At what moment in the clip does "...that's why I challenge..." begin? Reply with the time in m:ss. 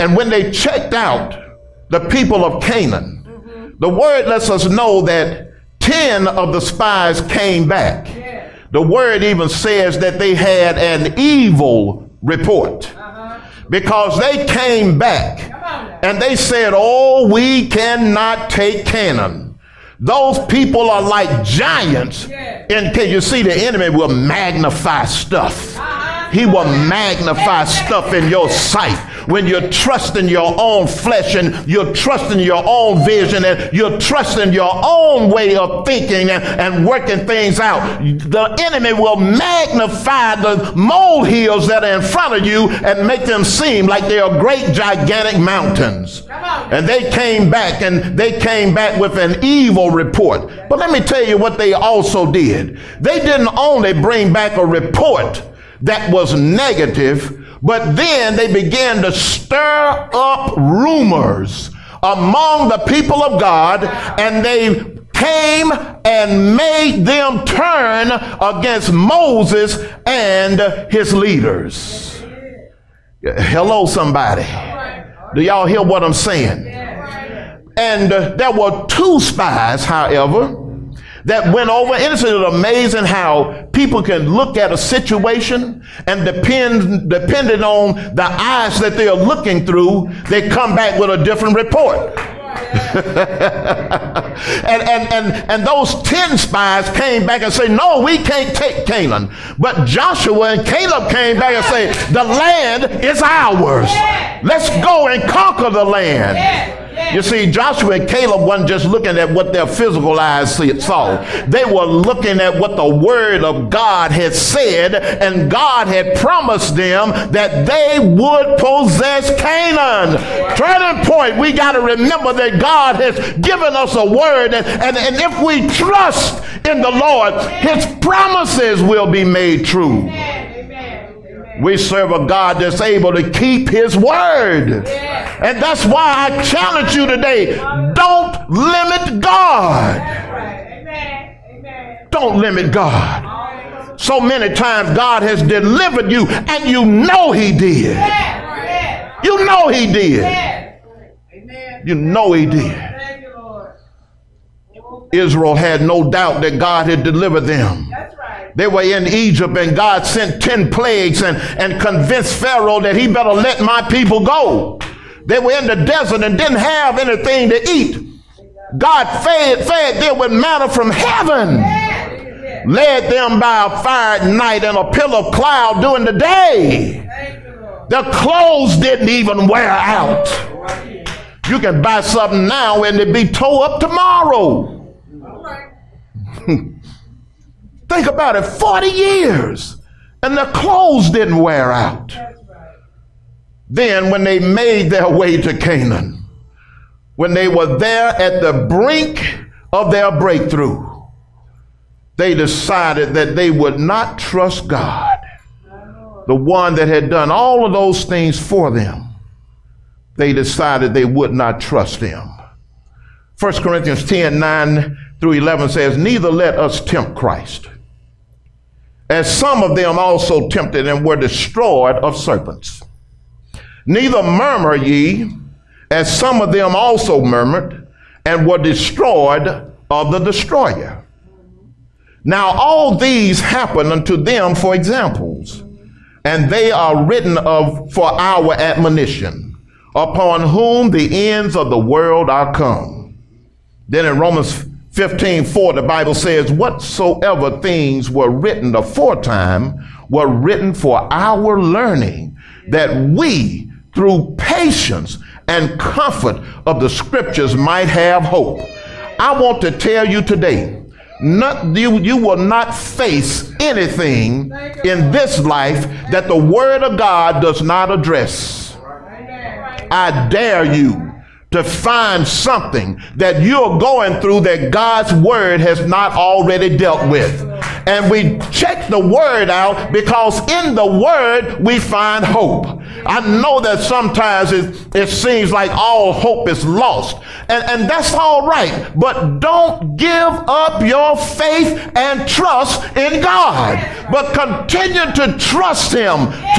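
2:15.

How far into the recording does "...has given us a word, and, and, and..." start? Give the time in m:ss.
2:02.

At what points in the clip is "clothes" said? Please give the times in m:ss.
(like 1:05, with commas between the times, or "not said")
2:58, 3:10.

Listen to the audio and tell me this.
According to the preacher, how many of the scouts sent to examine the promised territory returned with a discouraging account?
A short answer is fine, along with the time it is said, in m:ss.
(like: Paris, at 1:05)
10, at 0:05.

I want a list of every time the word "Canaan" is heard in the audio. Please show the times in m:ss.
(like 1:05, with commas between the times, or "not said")
0:02, 0:18, 1:38, 1:59, 3:15.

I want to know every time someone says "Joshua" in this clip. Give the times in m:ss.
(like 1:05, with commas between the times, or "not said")
1:39, 1:47.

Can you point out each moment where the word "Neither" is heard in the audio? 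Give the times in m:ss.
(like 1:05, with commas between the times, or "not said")
3:35, 3:43.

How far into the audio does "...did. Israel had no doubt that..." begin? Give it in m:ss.
2:32.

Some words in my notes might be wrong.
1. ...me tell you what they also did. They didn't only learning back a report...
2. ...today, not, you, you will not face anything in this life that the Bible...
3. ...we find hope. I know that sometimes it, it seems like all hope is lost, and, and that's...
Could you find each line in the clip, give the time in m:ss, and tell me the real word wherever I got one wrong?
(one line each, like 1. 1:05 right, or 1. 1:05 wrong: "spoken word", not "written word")
1. 0:50 wrong: "bring", not "learning"
2. 4:20 wrong: "Word", not "Bible"
3. 4:41 right.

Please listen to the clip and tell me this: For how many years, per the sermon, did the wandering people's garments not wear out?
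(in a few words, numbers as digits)
40.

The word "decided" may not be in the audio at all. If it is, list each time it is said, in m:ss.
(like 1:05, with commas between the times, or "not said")
3:22, 3:30.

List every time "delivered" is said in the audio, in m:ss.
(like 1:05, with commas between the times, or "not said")
2:25, 2:37.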